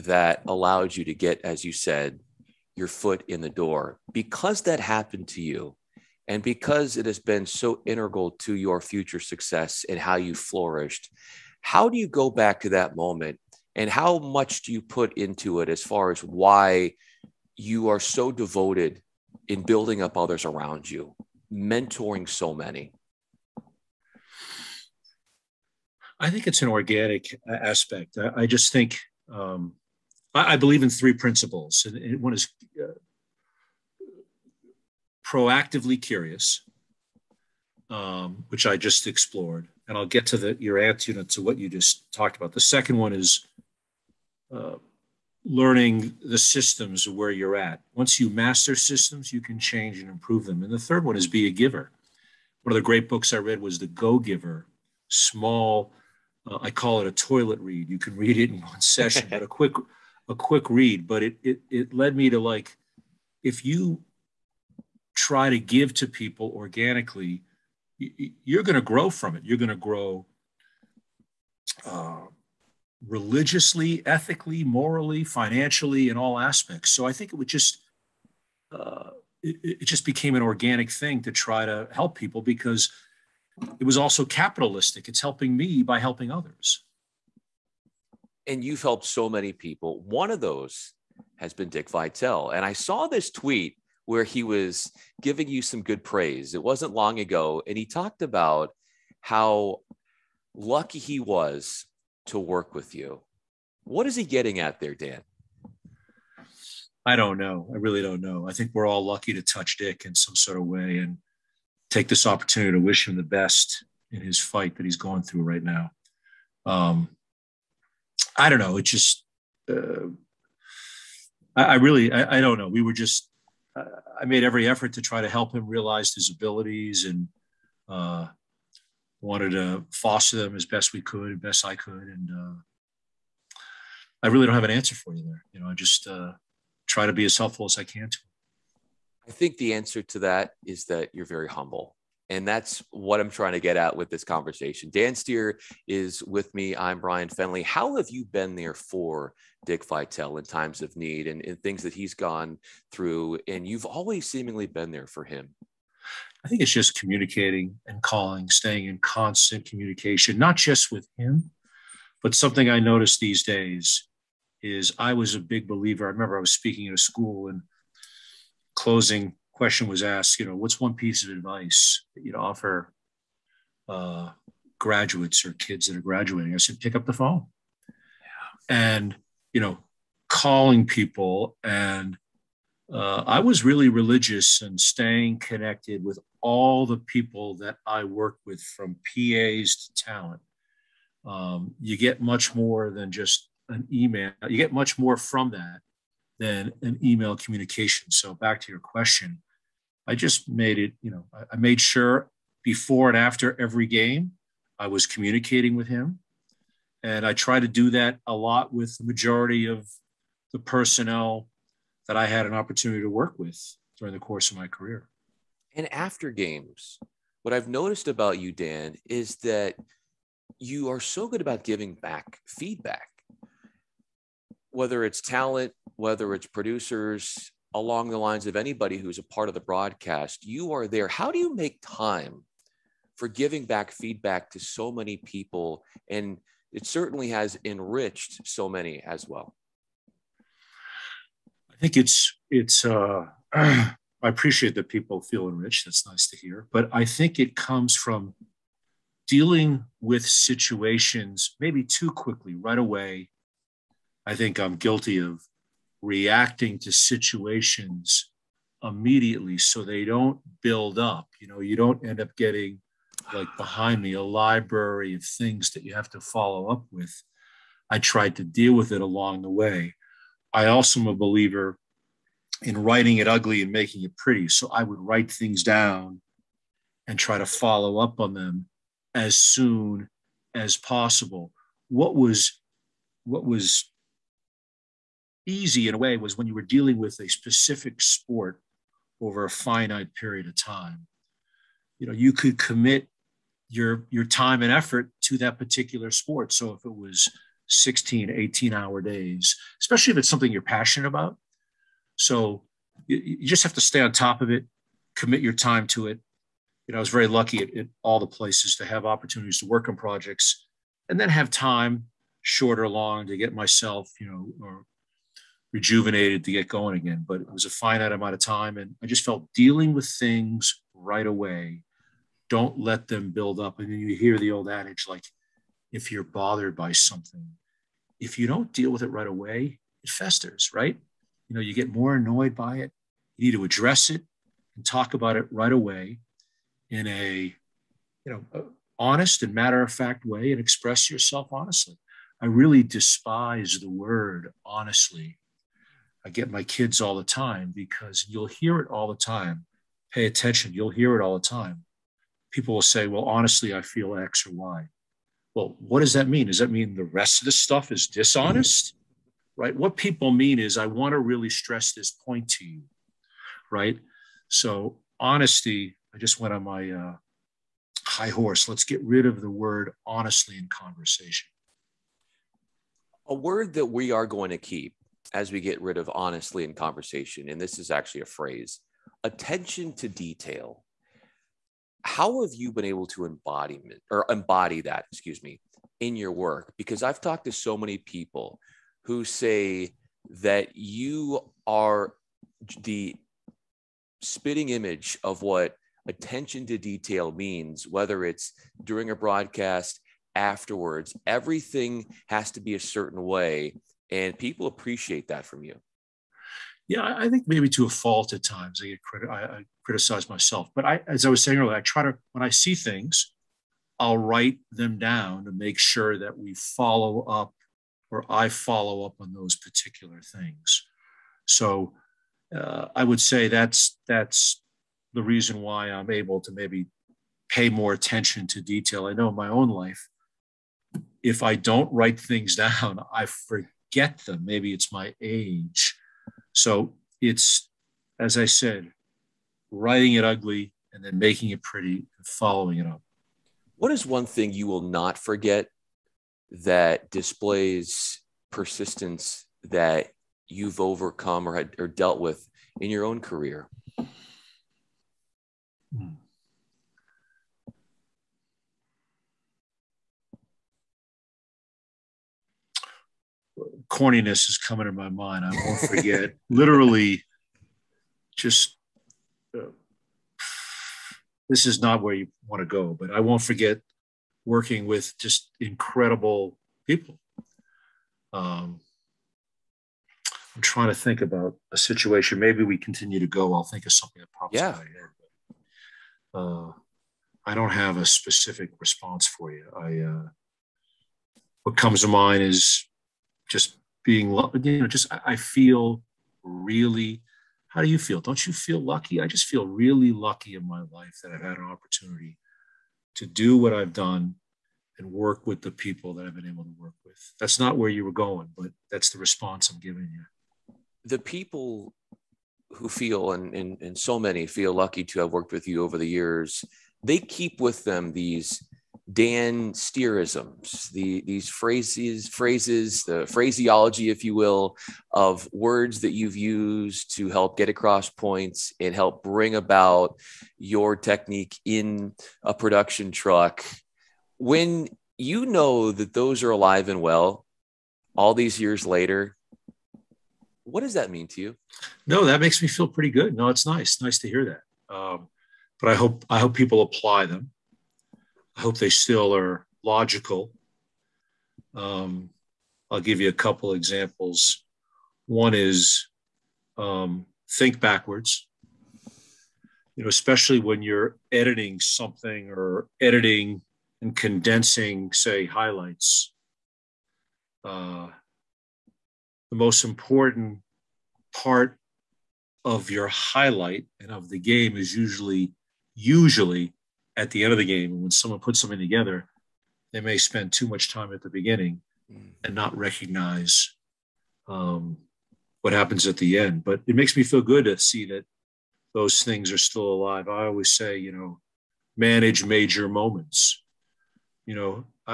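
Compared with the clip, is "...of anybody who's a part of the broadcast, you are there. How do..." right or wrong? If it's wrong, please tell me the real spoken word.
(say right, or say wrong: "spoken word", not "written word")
right.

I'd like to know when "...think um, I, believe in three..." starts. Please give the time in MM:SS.
00:28.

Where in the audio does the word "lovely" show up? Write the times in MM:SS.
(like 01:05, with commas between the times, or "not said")
not said.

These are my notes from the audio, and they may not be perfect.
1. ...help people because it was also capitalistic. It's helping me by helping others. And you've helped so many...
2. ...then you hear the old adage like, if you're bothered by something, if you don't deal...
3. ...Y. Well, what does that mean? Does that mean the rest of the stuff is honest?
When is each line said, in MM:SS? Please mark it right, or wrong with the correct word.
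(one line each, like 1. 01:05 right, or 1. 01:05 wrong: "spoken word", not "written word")
1. 01:21 right
2. 05:23 right
3. 05:54 wrong: "dishonest", not "honest".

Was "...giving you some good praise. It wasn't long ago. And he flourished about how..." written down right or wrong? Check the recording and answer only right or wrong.
wrong.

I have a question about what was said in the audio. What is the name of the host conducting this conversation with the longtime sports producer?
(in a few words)
Bryan Fenley.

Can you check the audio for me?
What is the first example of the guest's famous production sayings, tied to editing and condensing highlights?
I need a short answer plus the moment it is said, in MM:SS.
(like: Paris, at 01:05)
Think backwards, at 09:17.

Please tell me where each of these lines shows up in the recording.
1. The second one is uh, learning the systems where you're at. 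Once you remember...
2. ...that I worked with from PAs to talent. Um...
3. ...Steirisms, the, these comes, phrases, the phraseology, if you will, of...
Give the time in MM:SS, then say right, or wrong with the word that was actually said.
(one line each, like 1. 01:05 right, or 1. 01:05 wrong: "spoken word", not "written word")
1. 00:42 wrong: "master", not "remember"
2. 03:07 right
3. 08:39 wrong: "phrases", not "comes".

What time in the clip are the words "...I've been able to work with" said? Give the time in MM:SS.
08:26.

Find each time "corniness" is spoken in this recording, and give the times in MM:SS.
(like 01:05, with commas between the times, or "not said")
07:43.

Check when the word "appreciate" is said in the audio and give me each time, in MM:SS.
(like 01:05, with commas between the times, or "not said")
04:04, 06:44.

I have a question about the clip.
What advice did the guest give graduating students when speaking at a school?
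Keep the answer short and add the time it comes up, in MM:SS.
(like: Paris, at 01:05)
Pick up the phone, at 02:56.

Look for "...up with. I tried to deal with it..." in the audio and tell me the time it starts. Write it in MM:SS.
04:26.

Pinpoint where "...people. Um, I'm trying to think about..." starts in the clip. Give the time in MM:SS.
07:56.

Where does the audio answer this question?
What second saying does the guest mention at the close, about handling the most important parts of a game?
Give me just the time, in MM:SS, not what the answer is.
09:51.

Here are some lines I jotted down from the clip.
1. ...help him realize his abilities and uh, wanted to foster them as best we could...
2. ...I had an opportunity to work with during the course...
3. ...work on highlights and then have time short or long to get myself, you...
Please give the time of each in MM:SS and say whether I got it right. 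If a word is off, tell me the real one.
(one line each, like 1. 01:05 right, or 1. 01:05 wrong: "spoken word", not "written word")
1. 02:05 right
2. 03:32 right
3. 05:09 wrong: "projects", not "highlights".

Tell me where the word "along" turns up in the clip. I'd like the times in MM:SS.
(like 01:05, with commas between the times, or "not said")
03:47, 04:29.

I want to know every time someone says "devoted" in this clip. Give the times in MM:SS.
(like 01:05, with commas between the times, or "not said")
00:18.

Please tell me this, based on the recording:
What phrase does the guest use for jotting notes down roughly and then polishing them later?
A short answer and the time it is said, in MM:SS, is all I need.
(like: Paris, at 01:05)
writing it ugly and making it pretty, at 04:32.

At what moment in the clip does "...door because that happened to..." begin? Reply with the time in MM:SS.
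00:03.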